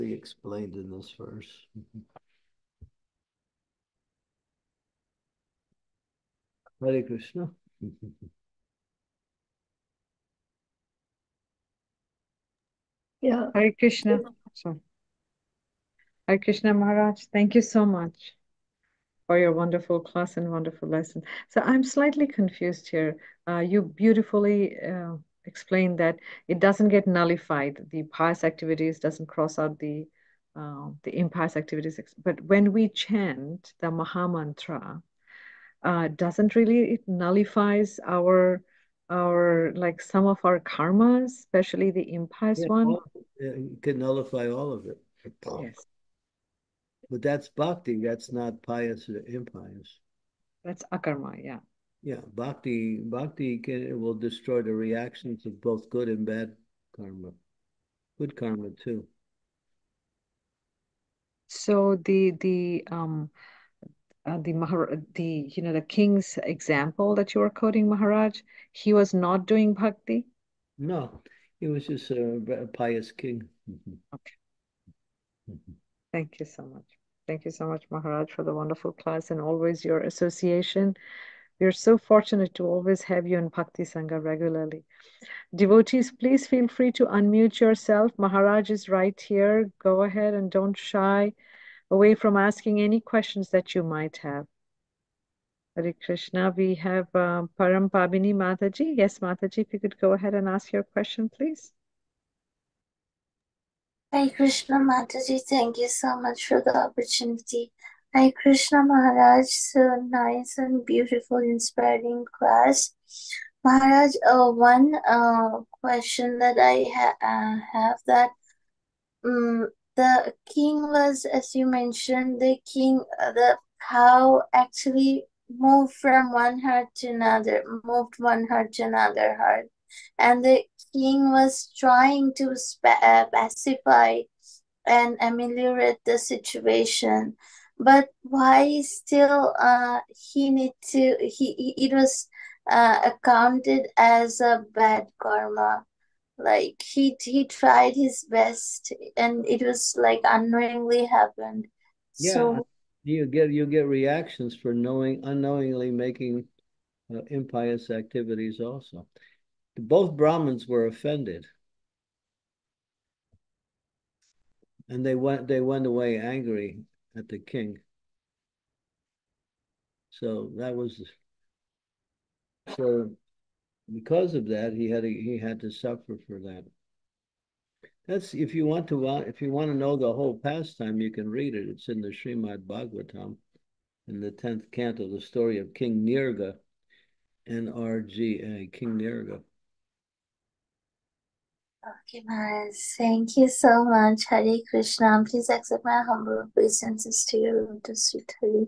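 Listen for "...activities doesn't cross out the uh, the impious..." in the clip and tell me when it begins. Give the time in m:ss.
0:28.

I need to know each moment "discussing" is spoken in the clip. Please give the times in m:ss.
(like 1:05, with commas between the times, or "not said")
not said.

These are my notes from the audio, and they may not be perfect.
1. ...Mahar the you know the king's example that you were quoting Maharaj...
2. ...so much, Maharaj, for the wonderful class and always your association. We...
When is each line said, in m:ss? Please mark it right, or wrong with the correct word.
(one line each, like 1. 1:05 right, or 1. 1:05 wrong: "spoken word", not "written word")
1. 1:04 right
2. 1:17 right.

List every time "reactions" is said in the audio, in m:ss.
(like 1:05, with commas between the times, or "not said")
0:54, 2:33.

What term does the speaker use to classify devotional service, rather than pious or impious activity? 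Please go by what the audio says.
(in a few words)
akarma.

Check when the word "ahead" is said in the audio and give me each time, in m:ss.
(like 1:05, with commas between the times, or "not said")
1:30, 1:40.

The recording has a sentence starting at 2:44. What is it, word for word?
And they went they went away angry at the king.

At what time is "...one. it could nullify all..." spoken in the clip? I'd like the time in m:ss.
0:42.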